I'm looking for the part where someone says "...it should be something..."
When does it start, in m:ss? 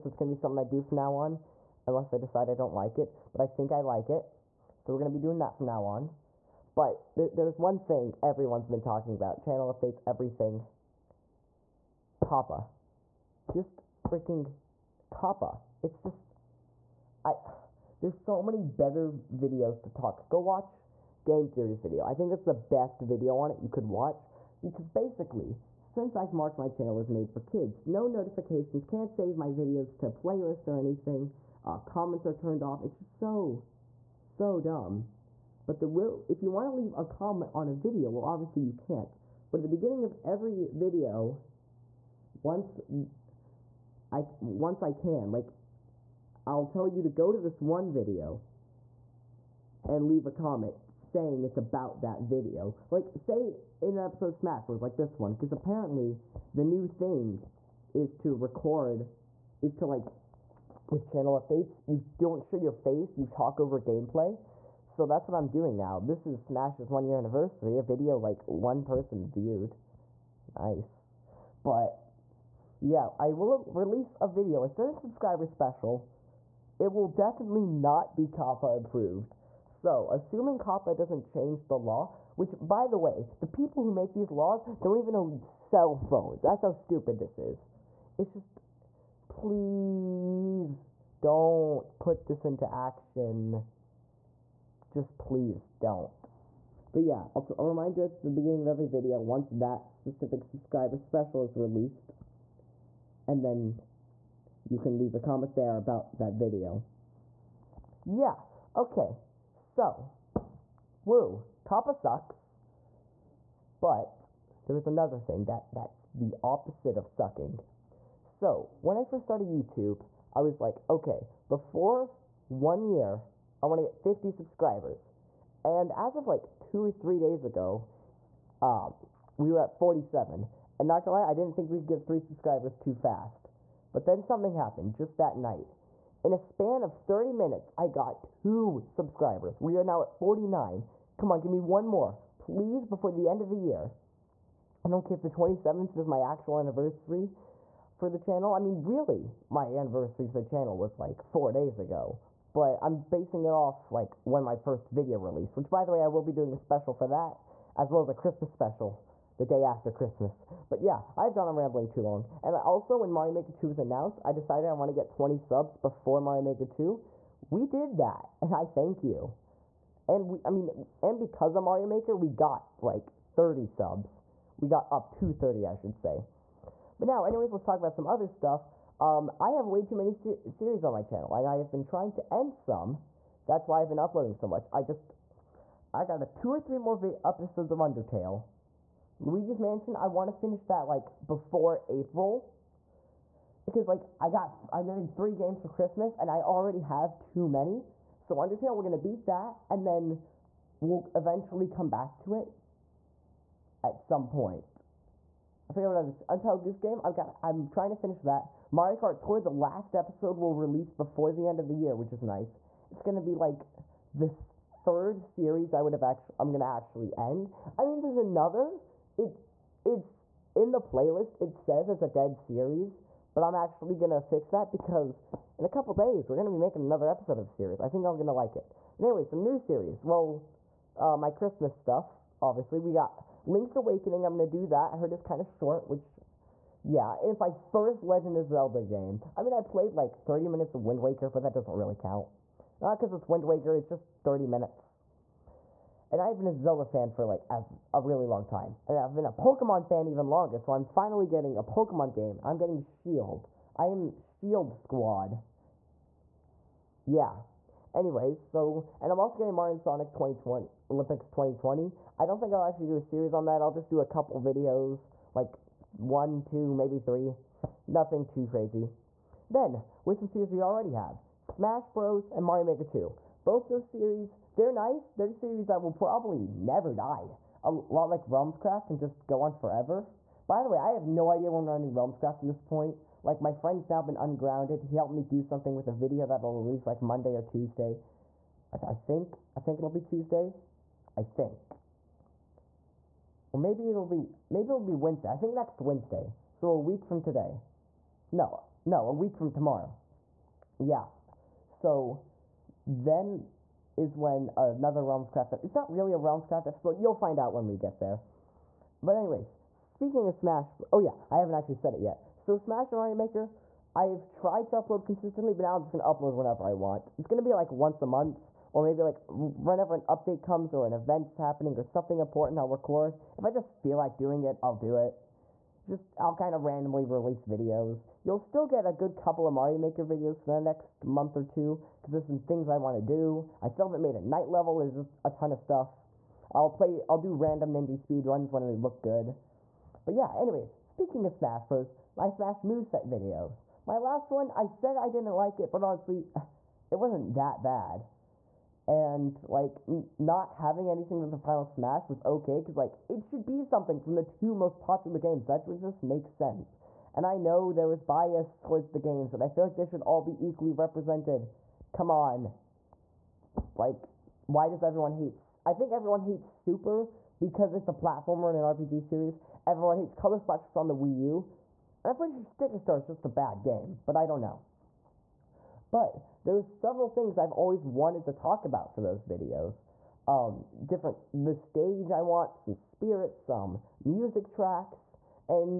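5:53.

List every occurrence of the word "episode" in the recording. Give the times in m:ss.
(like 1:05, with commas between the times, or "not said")
0:54, 3:07, 3:29, 3:47, 5:06.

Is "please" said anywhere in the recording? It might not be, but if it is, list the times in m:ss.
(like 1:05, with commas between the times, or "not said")
1:29, 1:35, 2:22.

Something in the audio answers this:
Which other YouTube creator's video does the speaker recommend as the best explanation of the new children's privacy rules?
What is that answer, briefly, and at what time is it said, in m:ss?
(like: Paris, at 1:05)
Game Theory, at 0:21.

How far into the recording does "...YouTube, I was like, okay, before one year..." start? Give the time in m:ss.
1:59.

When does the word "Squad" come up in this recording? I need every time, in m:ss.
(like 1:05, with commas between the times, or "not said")
4:14.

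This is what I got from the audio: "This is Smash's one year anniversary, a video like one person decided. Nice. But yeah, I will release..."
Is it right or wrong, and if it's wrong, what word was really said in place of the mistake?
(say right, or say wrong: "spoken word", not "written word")
wrong: "viewed", not "decided".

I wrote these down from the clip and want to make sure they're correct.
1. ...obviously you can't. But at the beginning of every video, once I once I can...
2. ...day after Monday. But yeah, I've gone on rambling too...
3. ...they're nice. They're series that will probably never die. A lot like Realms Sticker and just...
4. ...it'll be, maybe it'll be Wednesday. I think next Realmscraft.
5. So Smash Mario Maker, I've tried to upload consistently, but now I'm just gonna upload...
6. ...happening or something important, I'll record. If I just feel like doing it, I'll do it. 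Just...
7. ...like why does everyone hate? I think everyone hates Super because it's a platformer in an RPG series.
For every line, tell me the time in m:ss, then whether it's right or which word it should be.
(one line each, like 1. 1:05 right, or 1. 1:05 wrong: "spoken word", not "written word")
1. 0:38 right
2. 2:39 wrong: "Christmas", not "Monday"
3. 4:34 wrong: "Craft", not "Sticker"
4. 4:53 wrong: "Wednesday", not "Realmscraft"
5. 5:12 right
6. 5:21 right
7. 6:03 right.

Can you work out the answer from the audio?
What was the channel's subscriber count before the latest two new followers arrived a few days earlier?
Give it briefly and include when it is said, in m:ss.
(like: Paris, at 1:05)
47, at 2:09.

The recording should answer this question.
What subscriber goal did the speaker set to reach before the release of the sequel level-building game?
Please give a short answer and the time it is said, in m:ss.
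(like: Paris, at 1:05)
20, at 2:45.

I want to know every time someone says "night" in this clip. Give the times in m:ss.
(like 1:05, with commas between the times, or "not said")
2:15, 5:34.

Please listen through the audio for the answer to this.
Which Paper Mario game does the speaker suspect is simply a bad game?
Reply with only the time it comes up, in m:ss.
6:12.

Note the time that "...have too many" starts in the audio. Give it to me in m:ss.
3:16.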